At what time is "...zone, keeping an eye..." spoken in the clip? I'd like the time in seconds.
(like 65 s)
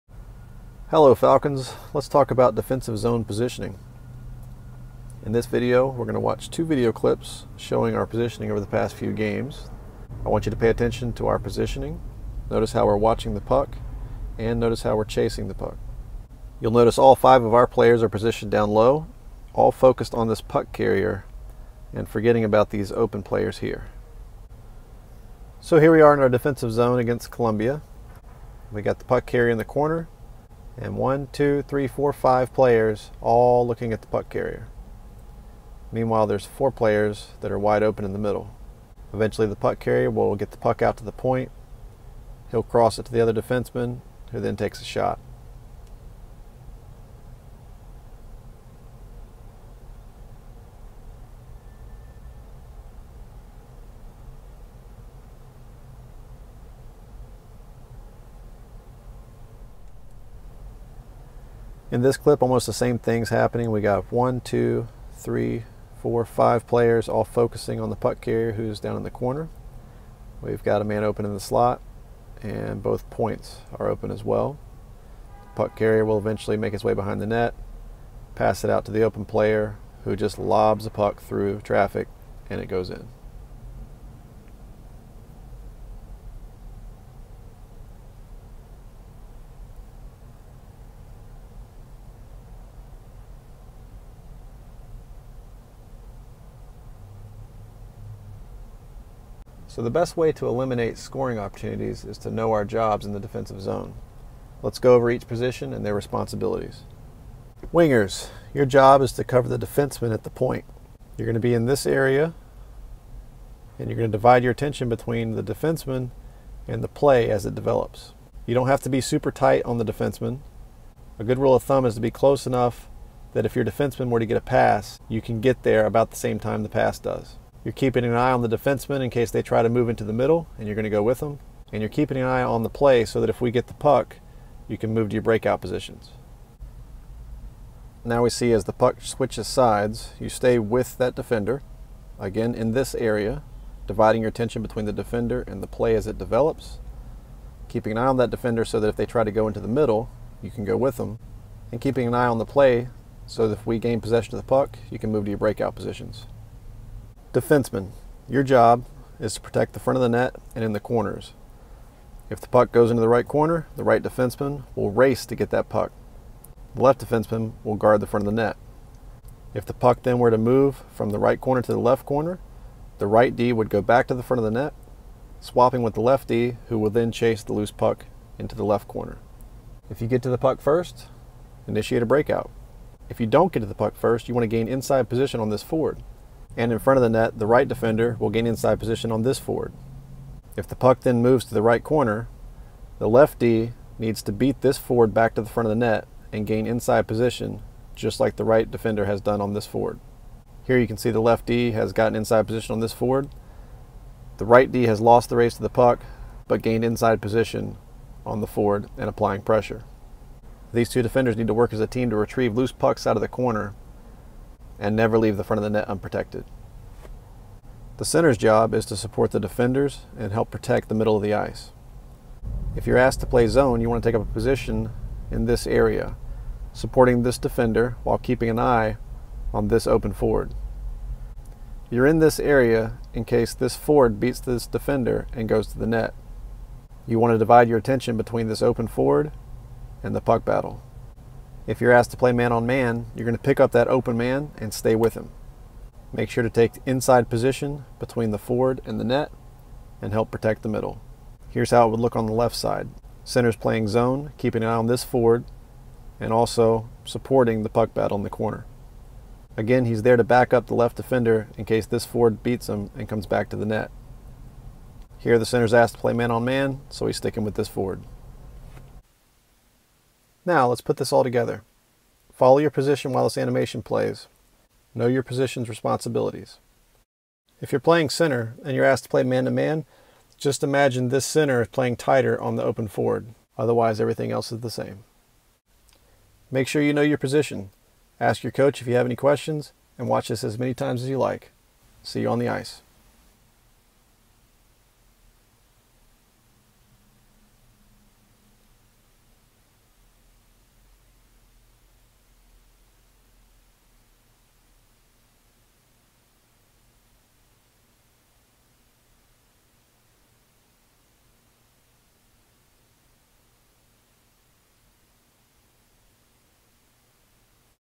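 253 s.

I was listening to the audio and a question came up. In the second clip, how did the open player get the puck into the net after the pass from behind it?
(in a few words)
lobs the puck through traffic.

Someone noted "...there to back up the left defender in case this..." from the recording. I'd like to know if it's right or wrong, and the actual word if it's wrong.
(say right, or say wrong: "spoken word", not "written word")
right.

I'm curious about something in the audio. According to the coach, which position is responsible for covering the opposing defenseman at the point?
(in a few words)
Wingers.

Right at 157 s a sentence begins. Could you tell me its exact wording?
Defenseman, your job is to protect the front of the net and in the corners.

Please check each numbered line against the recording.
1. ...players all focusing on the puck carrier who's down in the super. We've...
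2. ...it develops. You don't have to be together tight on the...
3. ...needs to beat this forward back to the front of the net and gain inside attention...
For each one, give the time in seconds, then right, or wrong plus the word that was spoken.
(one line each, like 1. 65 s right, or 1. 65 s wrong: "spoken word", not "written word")
1. 66 s wrong: "corner", not "super"
2. 117 s wrong: "super", not "together"
3. 193 s wrong: "position", not "attention".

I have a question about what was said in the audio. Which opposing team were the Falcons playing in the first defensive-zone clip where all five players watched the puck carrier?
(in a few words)
Columbia.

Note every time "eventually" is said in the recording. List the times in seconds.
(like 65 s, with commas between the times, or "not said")
39 s, 76 s.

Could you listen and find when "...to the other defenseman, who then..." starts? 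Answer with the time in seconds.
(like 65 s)
43 s.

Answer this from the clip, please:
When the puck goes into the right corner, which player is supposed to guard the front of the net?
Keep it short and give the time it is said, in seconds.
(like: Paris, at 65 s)
The left defenseman, at 166 s.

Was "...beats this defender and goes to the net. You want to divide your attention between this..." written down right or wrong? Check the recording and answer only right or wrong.
right.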